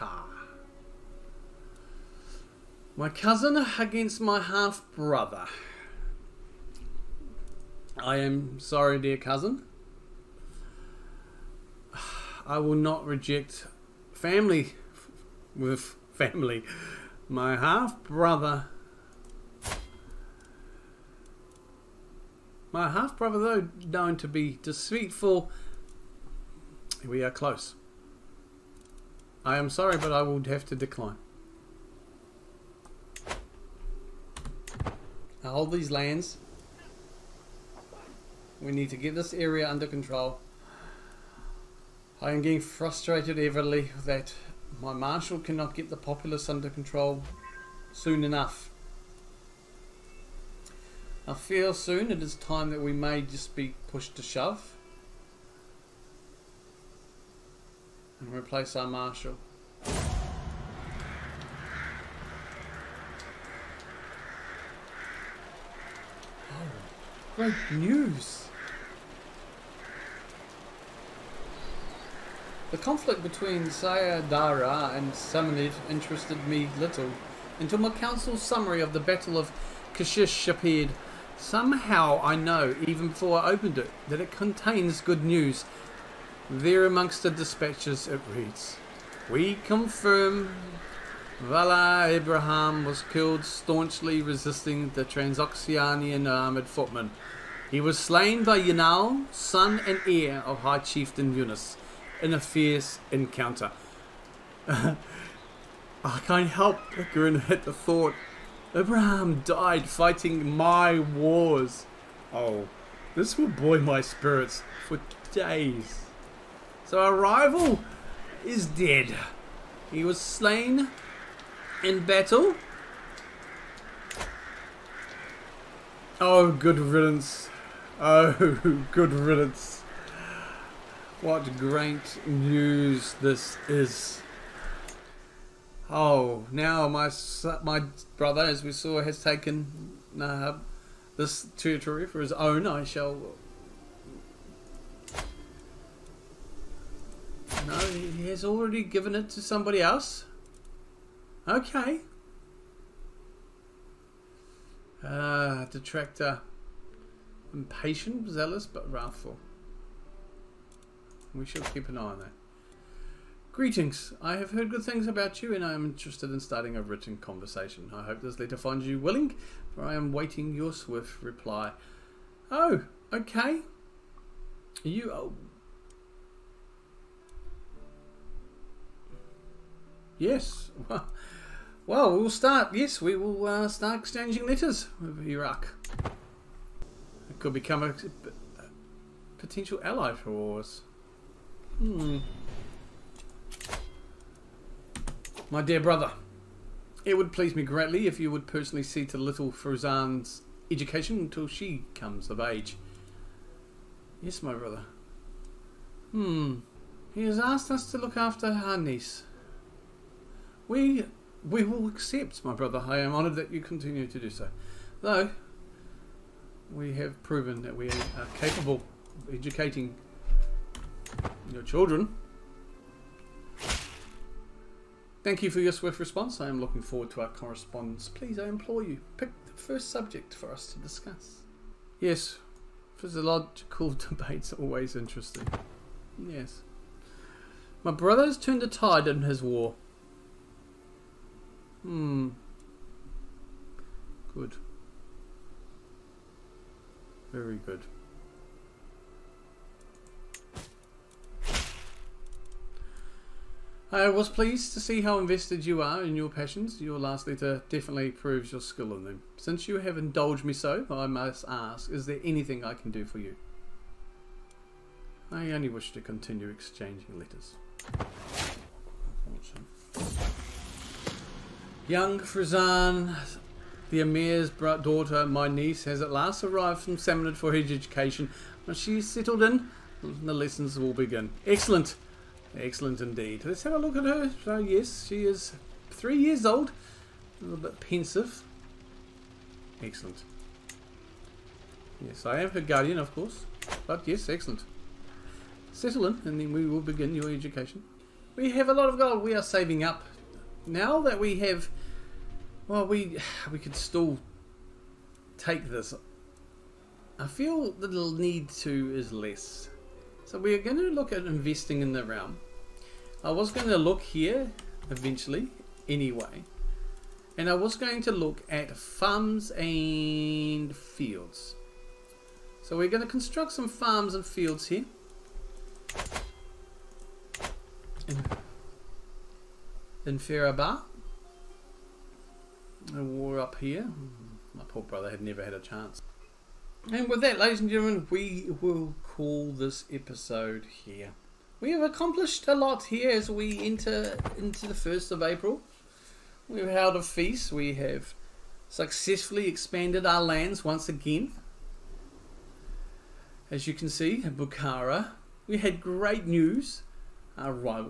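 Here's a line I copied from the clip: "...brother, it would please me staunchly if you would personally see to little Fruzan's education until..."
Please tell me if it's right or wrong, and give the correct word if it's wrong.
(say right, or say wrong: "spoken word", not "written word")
wrong: "greatly", not "staunchly".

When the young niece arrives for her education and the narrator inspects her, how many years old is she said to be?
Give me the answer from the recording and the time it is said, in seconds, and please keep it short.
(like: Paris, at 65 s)
3, at 285 s.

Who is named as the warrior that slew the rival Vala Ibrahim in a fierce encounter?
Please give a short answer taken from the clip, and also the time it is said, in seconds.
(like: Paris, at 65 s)
Yanal, at 98 s.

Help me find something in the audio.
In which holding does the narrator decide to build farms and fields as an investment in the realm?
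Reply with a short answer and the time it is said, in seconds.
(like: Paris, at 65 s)
Farabar, at 330 s.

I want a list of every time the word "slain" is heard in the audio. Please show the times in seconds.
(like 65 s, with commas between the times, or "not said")
97 s, 120 s.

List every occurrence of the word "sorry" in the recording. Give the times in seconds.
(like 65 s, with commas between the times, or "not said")
8 s, 29 s.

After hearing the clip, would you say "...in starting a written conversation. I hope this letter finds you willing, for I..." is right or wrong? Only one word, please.
right.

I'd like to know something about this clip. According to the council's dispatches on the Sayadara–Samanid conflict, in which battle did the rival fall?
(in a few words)
Battle of Kashish.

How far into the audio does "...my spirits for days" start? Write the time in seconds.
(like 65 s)
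113 s.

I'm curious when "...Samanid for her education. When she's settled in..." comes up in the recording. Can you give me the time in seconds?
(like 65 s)
276 s.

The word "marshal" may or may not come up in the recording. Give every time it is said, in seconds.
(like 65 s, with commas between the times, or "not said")
44 s, 58 s.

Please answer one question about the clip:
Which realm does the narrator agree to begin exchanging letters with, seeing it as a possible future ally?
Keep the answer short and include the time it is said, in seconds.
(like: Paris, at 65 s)
Iraq, at 185 s.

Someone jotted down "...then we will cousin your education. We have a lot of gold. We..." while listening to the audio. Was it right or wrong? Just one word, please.
wrong.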